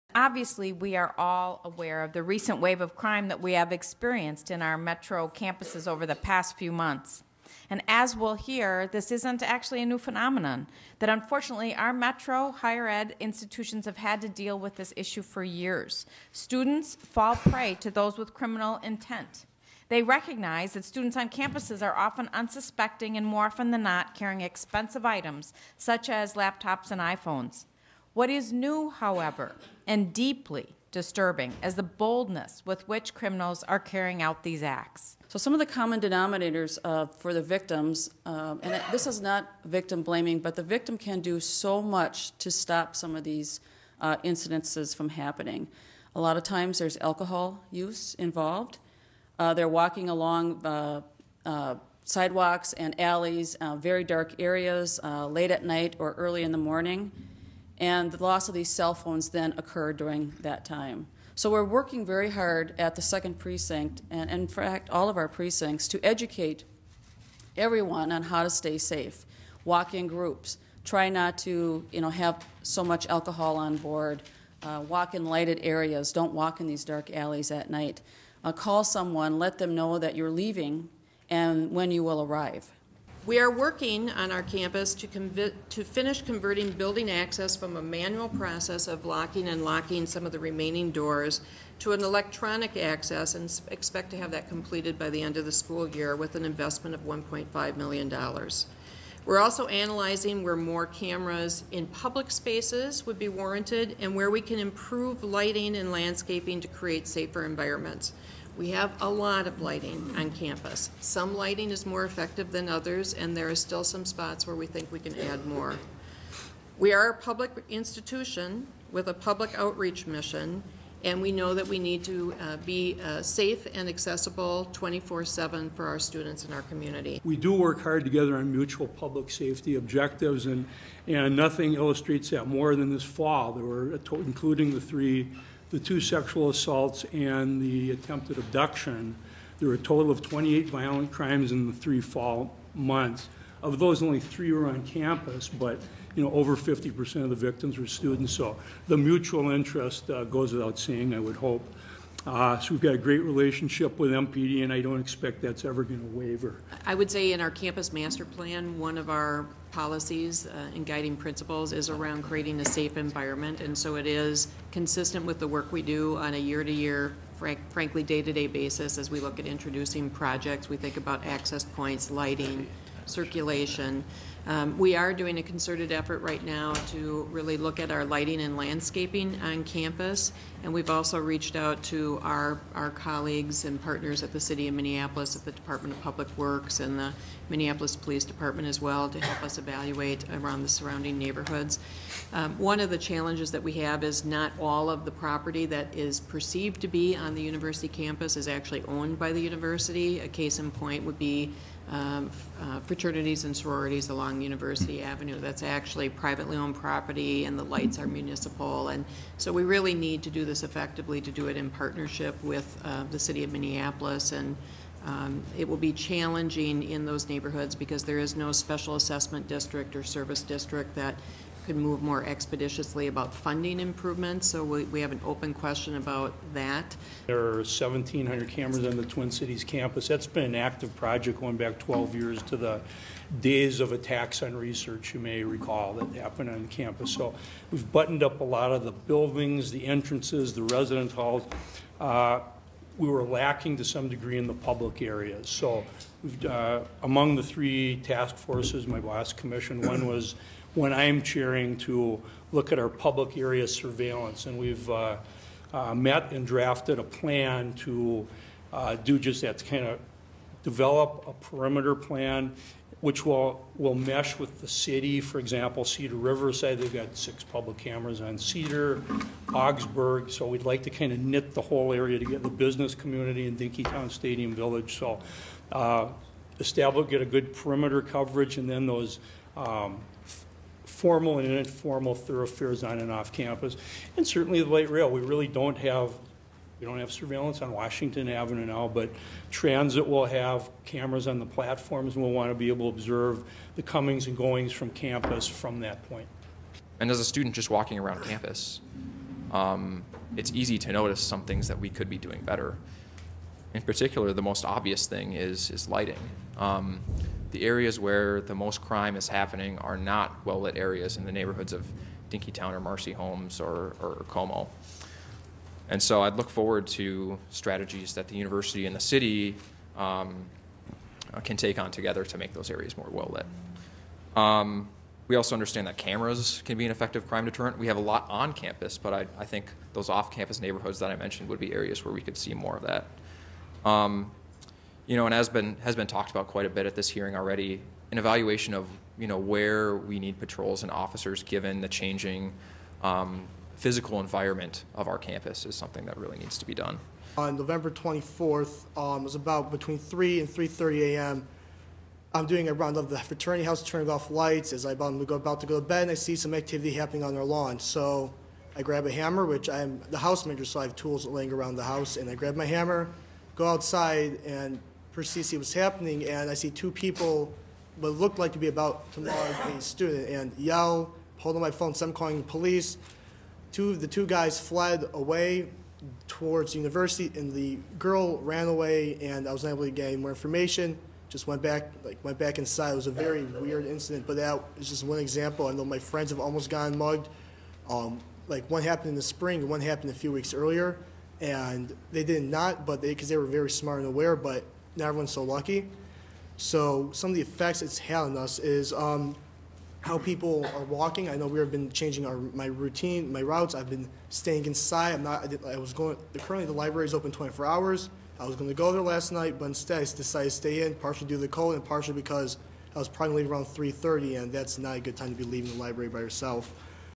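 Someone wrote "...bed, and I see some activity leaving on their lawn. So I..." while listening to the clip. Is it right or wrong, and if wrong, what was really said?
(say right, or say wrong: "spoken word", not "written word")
wrong: "happening", not "leaving".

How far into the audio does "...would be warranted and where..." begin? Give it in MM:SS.
01:43.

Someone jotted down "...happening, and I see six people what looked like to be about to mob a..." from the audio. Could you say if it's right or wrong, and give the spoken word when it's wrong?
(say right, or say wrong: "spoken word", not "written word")
wrong: "two", not "six".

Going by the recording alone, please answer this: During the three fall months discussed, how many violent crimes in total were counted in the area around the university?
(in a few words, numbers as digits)
28.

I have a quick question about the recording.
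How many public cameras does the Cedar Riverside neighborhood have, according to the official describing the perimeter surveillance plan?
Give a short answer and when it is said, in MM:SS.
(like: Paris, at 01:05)
6, at 04:27.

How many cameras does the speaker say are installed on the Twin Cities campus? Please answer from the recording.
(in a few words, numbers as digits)
1,700.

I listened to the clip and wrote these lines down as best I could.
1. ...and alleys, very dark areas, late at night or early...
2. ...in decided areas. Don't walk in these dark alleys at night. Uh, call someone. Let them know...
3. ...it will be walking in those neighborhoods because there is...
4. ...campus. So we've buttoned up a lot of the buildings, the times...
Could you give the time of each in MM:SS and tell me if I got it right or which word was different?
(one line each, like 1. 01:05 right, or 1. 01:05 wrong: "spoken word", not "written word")
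1. 00:52 right
2. 01:15 wrong: "lighted", not "decided"
3. 03:35 wrong: "challenging", not "walking"
4. 03:56 wrong: "entrances", not "times".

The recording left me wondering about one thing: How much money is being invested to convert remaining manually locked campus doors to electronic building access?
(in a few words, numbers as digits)
$1.5 million.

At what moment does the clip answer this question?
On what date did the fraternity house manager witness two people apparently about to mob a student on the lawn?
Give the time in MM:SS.
05:47.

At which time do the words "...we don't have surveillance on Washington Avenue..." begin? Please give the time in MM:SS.
04:46.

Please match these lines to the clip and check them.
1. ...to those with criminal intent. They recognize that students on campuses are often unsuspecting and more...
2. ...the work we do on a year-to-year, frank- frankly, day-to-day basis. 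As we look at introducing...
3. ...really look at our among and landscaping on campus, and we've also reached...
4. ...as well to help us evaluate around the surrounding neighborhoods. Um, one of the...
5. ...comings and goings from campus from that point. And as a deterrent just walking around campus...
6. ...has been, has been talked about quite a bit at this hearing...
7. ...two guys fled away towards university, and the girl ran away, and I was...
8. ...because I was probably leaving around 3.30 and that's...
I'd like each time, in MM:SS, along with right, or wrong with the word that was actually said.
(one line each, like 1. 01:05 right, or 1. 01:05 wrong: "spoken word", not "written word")
1. 00:17 right
2. 02:45 right
3. 02:57 wrong: "lighting", not "among"
4. 03:08 right
5. 04:53 wrong: "student", not "deterrent"
6. 05:35 right
7. 06:14 right
8. 06:52 right.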